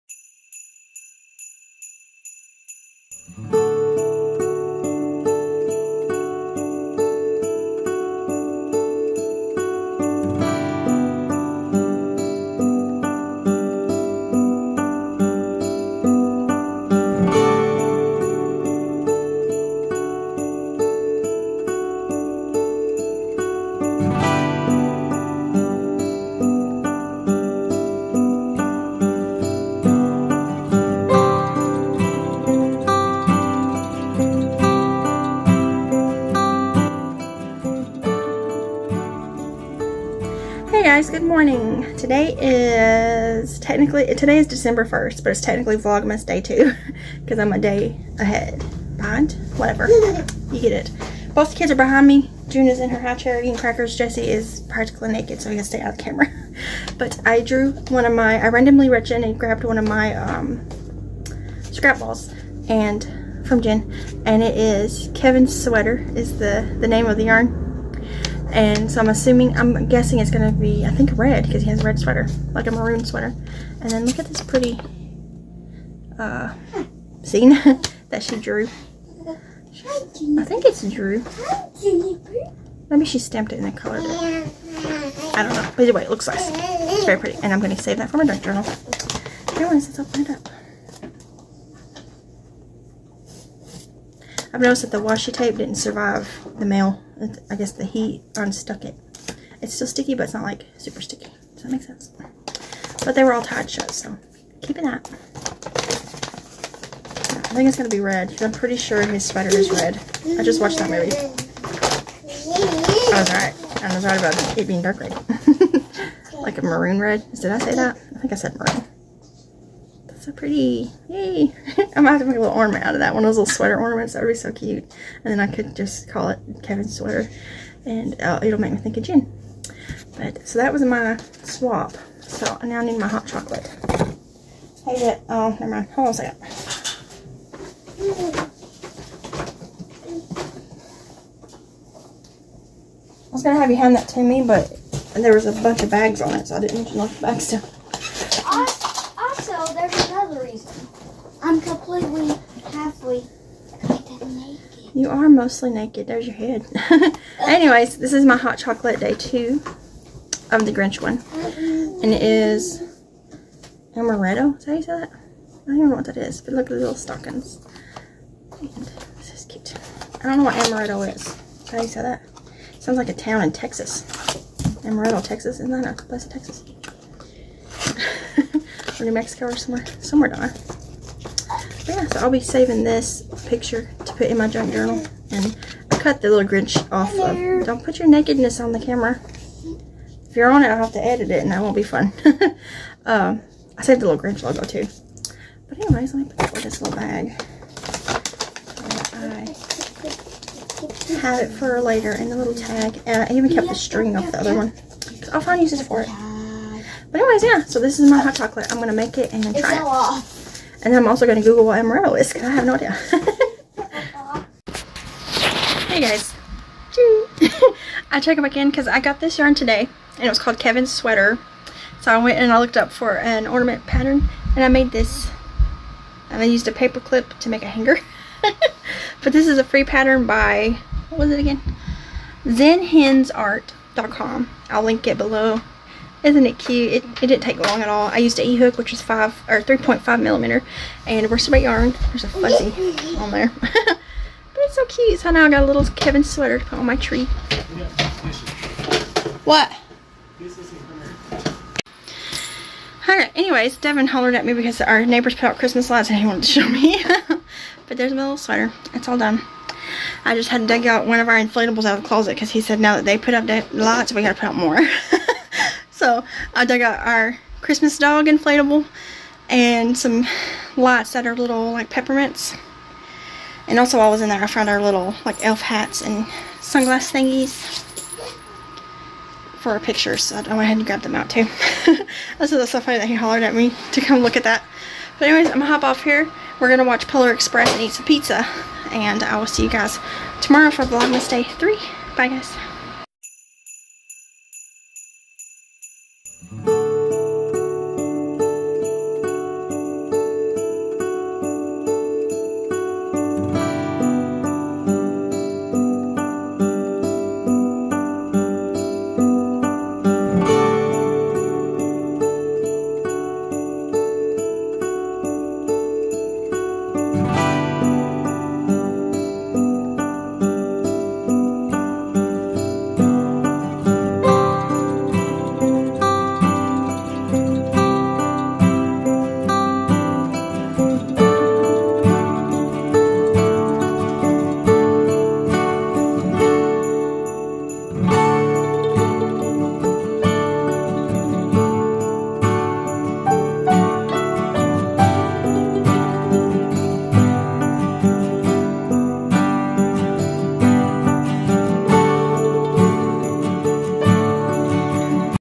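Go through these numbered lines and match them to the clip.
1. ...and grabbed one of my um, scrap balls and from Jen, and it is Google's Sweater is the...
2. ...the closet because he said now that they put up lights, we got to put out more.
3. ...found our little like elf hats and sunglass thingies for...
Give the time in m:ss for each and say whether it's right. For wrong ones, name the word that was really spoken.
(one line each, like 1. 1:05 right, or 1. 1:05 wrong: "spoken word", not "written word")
1. 0:59 wrong: "Kevin", not "Google"
2. 4:22 right
3. 4:34 right.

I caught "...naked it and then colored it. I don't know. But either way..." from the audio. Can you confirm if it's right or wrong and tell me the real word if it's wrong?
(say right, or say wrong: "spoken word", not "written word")
wrong: "stamped", not "naked".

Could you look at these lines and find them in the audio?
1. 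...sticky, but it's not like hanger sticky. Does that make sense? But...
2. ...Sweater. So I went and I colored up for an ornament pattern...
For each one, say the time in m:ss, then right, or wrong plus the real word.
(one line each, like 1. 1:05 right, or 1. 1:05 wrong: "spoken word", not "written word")
1. 1:39 wrong: "super", not "hanger"
2. 3:40 wrong: "looked", not "colored".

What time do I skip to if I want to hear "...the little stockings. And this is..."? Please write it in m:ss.
2:46.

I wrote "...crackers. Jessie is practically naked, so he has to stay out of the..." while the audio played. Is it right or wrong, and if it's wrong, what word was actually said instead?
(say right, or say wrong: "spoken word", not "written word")
right.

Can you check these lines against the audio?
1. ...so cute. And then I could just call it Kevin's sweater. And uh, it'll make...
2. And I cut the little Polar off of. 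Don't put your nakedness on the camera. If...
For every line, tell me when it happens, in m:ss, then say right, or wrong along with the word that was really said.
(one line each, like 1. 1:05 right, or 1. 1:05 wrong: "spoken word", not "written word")
1. 2:04 right
2. 3:05 wrong: "Grinch", not "Polar".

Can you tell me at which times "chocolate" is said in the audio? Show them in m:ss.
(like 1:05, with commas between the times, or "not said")
2:13, 2:38, 3:28.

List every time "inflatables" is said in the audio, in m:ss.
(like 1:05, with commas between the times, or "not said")
4:21, 4:28.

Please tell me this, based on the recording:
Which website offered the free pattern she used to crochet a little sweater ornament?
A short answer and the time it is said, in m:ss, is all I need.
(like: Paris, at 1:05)
zenhensart.com, at 3:52.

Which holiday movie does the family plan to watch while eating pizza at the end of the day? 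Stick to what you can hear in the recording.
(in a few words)
Polar Express.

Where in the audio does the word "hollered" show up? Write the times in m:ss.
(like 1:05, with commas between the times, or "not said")
4:14, 4:43.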